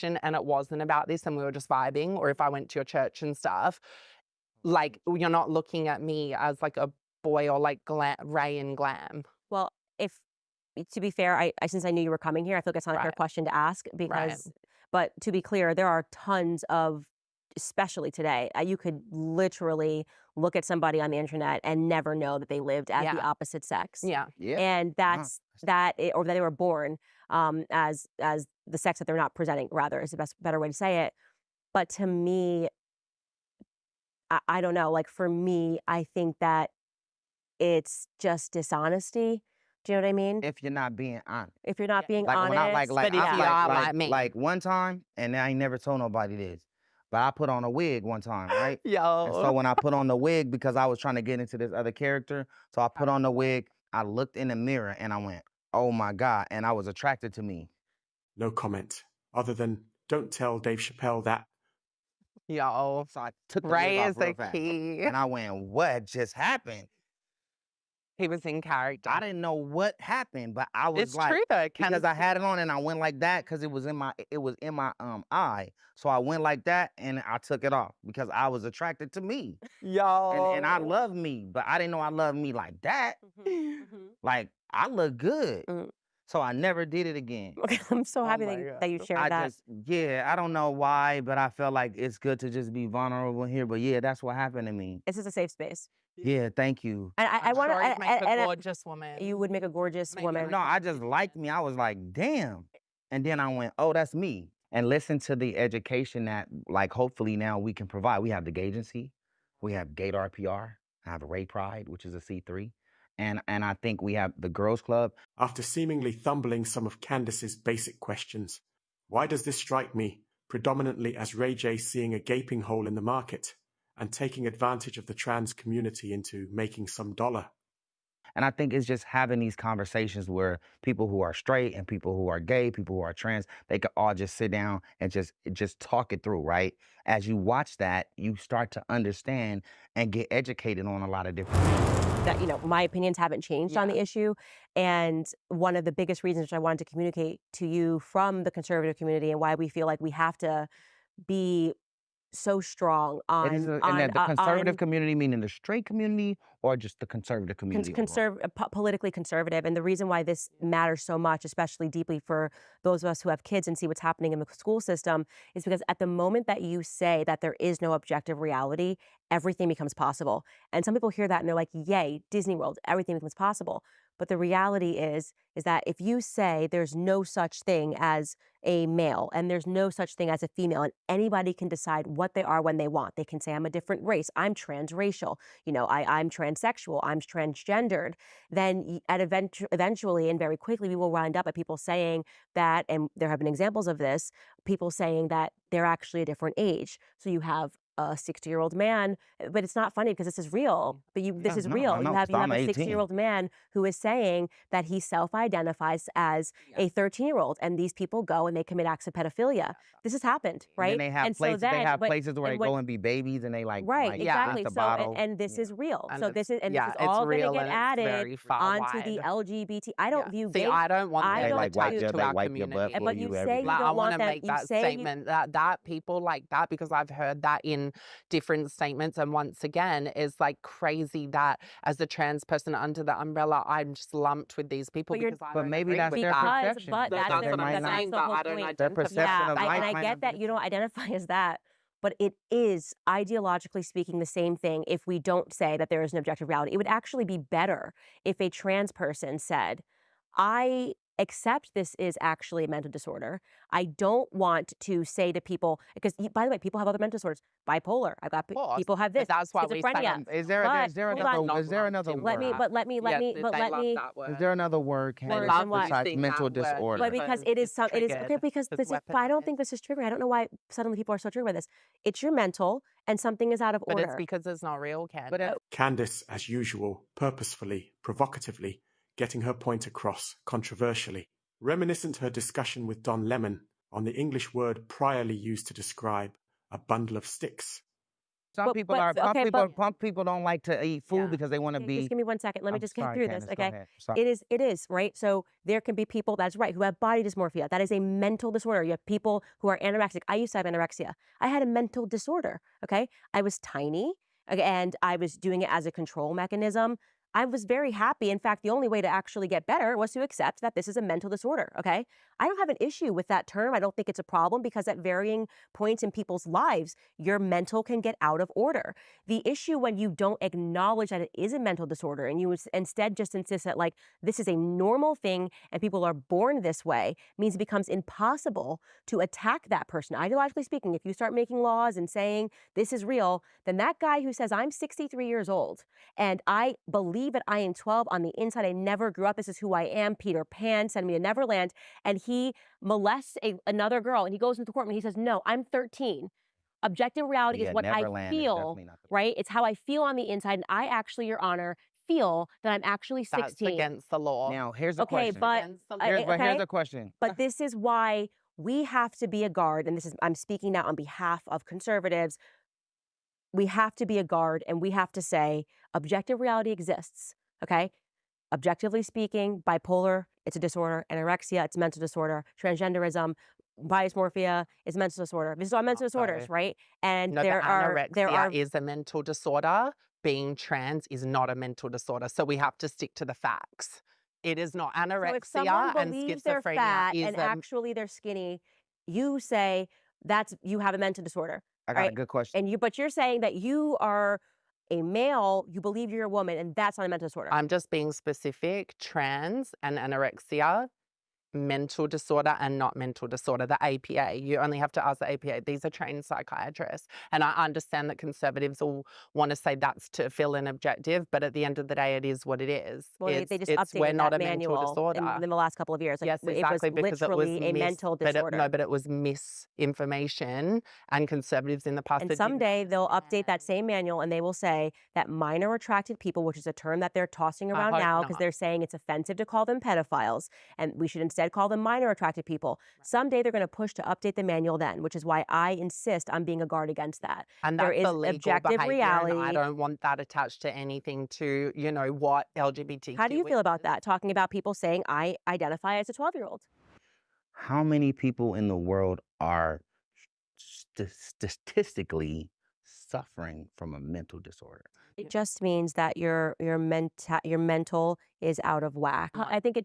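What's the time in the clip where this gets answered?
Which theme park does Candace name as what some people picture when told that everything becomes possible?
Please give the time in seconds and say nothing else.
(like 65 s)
172 s.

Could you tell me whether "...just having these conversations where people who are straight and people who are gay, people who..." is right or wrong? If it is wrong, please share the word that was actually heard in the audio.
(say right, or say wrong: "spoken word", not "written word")
right.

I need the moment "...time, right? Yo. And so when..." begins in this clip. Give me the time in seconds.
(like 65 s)
48 s.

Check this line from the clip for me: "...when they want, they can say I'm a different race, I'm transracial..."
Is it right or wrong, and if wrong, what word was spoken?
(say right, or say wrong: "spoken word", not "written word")
right.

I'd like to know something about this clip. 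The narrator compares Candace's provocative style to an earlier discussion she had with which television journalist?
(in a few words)
Don Lemon.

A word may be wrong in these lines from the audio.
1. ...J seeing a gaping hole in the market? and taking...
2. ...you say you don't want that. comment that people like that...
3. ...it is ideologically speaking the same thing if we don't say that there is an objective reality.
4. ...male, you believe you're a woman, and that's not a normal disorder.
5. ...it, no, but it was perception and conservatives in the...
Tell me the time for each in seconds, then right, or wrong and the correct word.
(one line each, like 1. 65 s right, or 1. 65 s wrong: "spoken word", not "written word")
1. 121 s right
2. 223 s wrong: "statement", not "comment"
3. 242 s right
4. 395 s wrong: "mental", not "normal"
5. 418 s wrong: "misinformation", not "perception".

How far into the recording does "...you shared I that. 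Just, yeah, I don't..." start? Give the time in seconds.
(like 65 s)
88 s.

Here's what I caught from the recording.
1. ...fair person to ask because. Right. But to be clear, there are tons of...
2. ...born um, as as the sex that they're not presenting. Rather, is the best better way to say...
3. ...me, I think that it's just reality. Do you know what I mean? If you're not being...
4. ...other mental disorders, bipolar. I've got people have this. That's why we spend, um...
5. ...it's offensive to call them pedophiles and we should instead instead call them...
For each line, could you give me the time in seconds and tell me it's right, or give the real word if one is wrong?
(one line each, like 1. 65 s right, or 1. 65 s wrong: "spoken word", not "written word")
1. 13 s wrong: "question", not "person"
2. 26 s right
3. 35 s wrong: "dishonesty", not "reality"
4. 256 s right
5. 428 s right.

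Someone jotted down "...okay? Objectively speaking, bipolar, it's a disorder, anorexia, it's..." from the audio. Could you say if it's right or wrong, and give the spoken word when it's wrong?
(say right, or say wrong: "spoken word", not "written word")
right.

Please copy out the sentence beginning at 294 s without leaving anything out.
Okay, it is it is right.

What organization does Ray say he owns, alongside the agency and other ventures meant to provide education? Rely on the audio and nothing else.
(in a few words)
Ray Pride.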